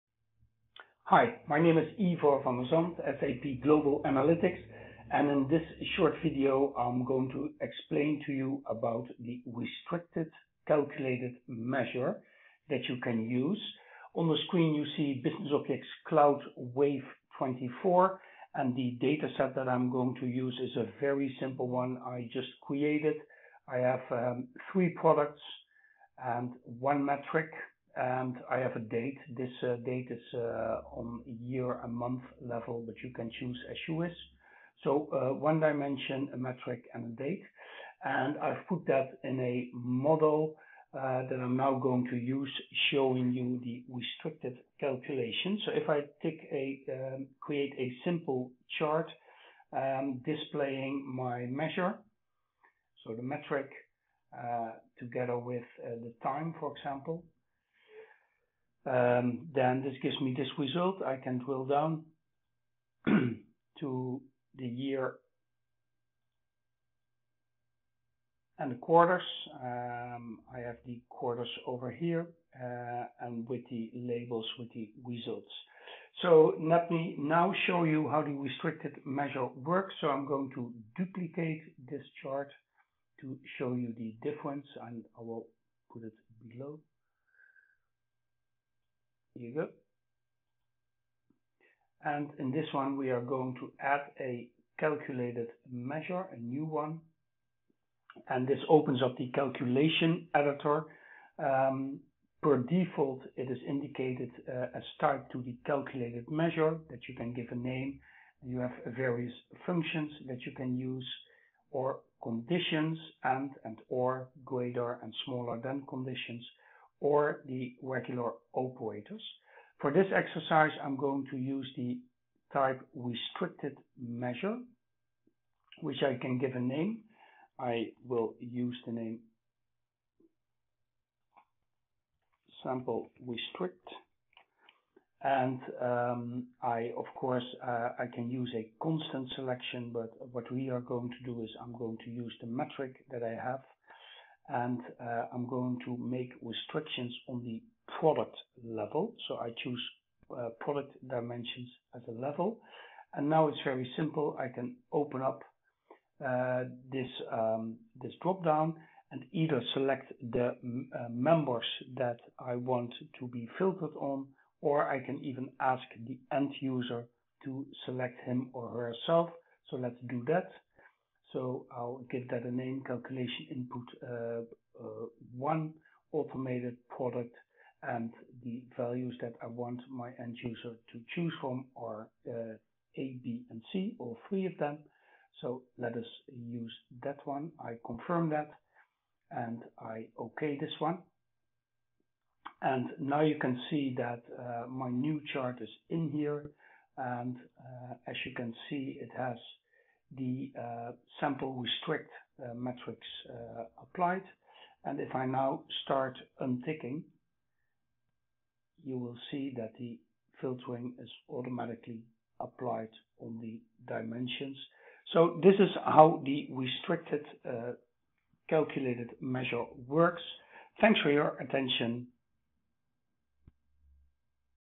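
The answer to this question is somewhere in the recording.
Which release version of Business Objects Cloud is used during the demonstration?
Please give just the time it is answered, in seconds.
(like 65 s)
16 s.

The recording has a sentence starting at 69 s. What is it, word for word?
Um, I have the quarters over here, uh, and with the labels with the results.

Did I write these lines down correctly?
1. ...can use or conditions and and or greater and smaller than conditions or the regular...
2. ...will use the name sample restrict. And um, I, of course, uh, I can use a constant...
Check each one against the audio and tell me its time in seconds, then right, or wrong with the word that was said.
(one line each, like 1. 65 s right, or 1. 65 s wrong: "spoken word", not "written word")
1. 110 s right
2. 128 s right.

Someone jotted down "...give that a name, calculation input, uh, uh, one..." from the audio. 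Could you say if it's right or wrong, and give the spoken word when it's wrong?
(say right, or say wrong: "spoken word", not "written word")
right.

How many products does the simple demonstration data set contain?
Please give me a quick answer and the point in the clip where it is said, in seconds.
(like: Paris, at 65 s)
3, at 24 s.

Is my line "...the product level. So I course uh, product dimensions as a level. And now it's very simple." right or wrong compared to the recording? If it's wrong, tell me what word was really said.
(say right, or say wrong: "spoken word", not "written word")
wrong: "choose", not "course".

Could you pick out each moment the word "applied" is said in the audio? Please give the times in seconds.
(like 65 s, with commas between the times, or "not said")
203 s, 212 s.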